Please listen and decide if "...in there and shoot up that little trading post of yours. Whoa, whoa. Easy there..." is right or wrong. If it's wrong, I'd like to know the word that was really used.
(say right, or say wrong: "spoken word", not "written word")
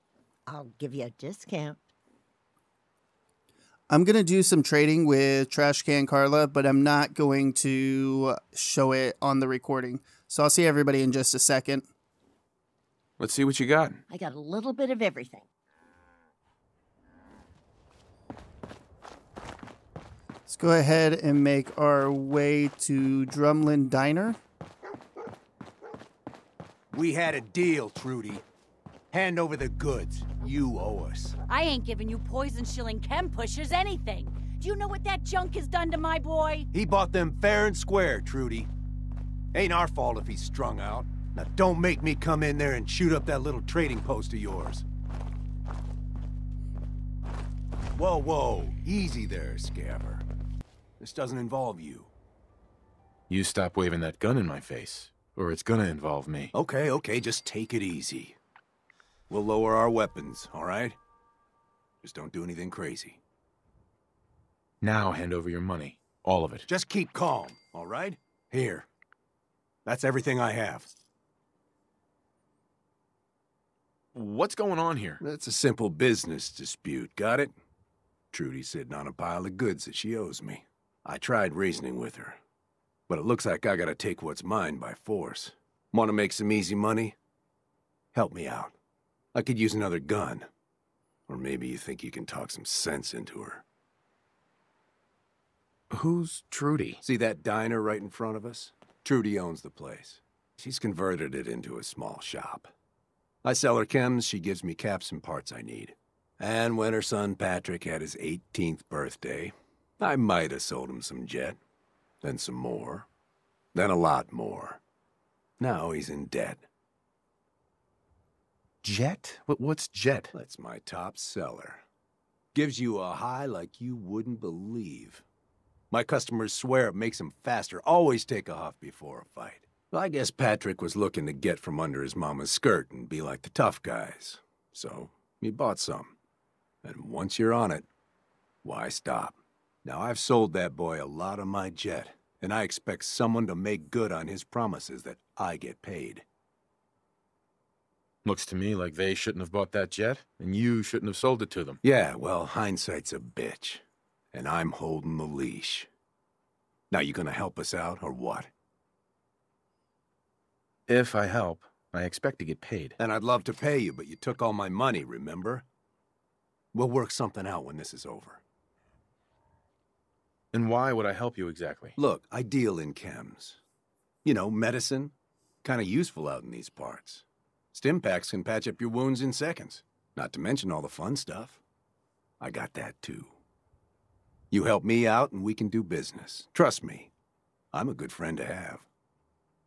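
right.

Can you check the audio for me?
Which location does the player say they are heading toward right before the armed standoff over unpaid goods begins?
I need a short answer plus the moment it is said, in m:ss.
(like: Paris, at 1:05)
Drumlin Diner, at 0:23.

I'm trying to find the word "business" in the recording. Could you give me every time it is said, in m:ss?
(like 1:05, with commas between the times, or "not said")
1:15, 3:05.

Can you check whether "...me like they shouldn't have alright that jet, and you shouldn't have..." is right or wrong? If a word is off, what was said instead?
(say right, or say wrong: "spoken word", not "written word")
wrong: "bought", not "alright".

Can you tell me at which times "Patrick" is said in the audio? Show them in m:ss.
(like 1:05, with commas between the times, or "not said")
1:47, 2:10.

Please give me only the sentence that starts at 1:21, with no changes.
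I tried reasoning with her, but it looks like I gotta take what's mine by force.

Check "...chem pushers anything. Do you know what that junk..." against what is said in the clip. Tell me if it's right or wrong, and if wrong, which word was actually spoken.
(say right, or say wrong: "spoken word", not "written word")
right.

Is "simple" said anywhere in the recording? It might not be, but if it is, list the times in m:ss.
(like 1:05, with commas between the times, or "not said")
1:15.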